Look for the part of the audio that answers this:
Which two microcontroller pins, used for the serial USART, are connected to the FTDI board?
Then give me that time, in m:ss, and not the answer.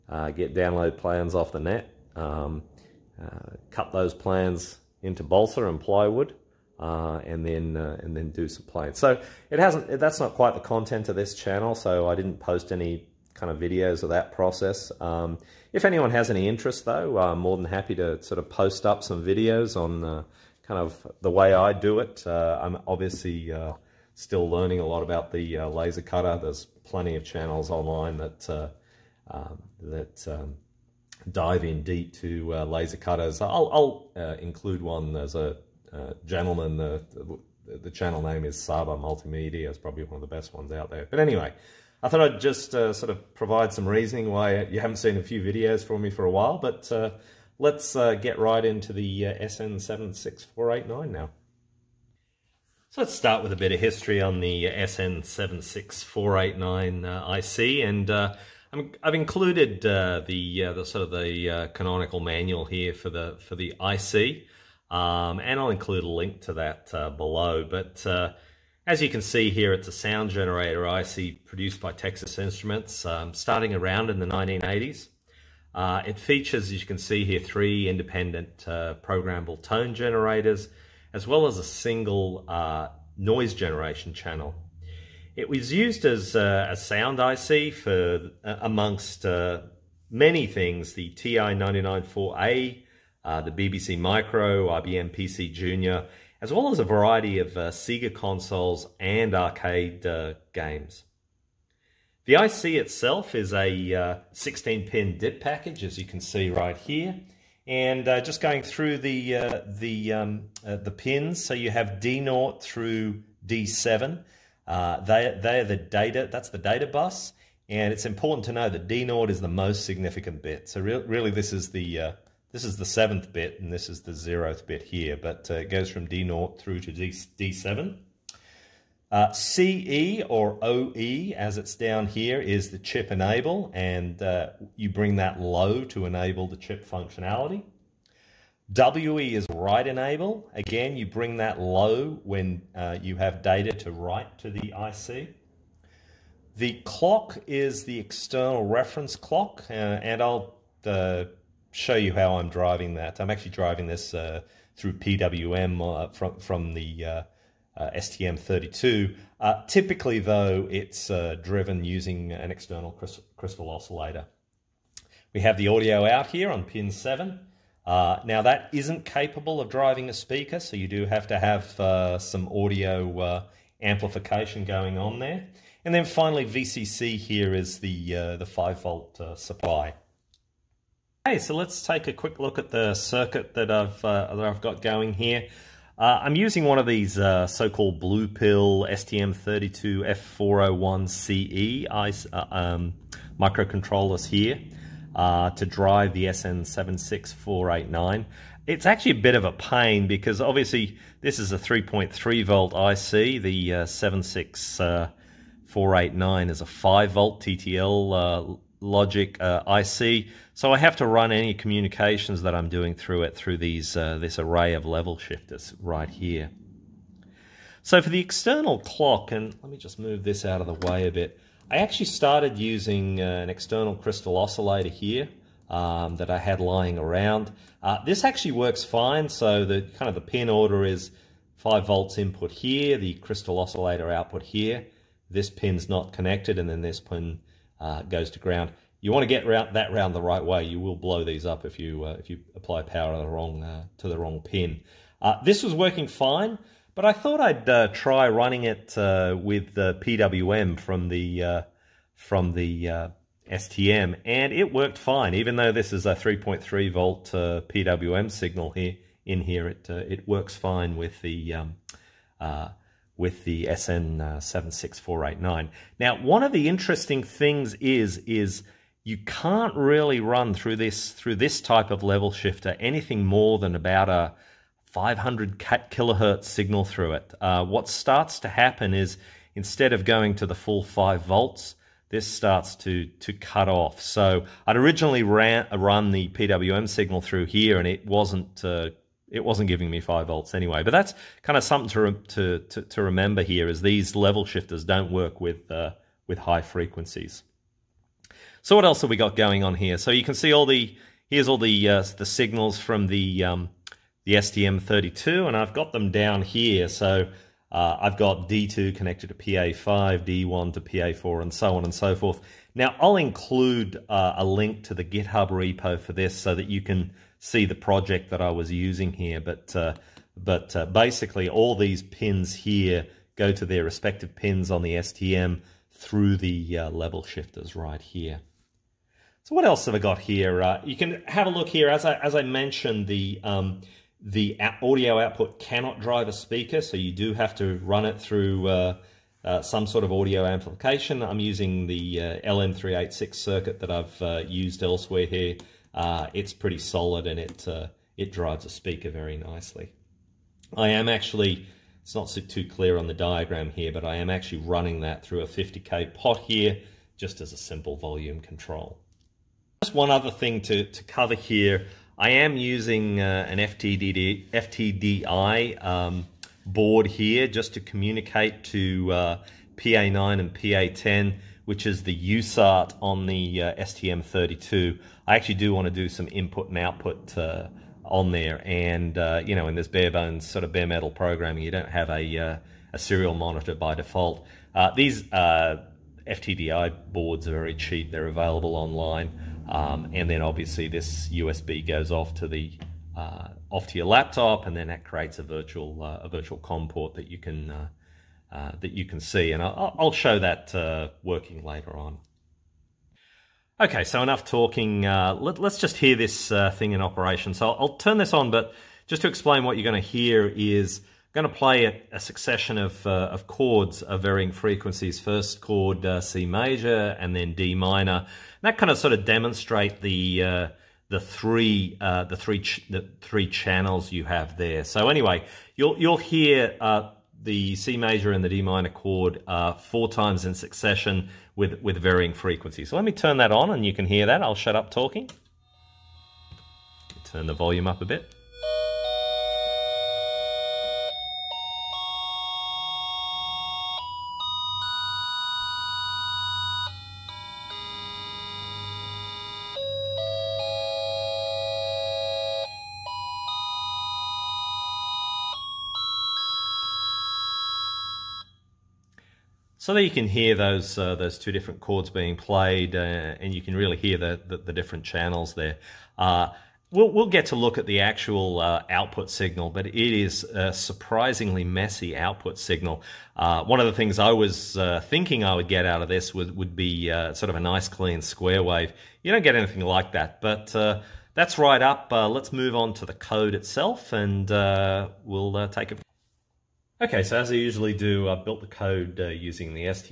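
6:09.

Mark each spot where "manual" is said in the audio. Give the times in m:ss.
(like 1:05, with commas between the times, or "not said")
1:02.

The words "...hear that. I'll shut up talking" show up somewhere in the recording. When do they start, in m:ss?
7:14.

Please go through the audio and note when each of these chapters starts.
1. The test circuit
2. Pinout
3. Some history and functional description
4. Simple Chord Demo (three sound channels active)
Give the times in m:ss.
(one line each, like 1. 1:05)
1. 3:00
2. 1:46
3. 0:51
4. 6:42.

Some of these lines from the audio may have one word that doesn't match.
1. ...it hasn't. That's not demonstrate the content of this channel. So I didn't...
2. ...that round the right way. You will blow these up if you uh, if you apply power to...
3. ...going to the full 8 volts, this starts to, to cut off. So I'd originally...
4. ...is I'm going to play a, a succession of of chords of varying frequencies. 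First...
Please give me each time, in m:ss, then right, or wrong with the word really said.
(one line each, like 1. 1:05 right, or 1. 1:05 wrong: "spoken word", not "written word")
1. 0:09 wrong: "quite", not "demonstrate"
2. 3:59 right
3. 4:40 wrong: "5", not "8"
4. 6:50 right.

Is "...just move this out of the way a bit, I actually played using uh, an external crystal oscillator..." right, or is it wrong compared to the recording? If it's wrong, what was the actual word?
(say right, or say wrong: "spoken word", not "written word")
wrong: "started", not "played".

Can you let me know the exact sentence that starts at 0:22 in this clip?
Uh, I'm obviously uh, still learning a lot about the laser cutter.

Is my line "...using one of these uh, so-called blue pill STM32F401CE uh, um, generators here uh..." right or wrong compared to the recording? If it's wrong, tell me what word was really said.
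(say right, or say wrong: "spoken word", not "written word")
wrong: "microcontrollers", not "generators".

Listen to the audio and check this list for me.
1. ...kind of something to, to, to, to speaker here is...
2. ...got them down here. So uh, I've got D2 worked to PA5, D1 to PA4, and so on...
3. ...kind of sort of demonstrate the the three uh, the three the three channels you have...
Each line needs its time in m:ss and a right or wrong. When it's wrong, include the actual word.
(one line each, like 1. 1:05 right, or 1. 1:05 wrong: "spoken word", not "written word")
1. 4:51 wrong: "remember", not "speaker"
2. 5:05 wrong: "connected", not "worked"
3. 6:58 right.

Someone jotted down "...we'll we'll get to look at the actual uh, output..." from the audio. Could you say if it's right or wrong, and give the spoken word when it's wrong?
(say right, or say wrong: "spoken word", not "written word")
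right.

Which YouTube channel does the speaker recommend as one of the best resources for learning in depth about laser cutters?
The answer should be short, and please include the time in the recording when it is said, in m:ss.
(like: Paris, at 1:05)
Sabar Multimedia, at 0:38.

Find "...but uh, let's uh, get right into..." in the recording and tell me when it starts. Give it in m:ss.
0:46.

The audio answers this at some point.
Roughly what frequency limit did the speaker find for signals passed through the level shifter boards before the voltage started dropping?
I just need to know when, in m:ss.
4:34.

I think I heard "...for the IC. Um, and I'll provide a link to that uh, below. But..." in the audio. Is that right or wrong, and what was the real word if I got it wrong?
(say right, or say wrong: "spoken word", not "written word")
wrong: "include", not "provide".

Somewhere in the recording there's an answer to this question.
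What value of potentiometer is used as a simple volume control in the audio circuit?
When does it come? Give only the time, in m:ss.
5:55.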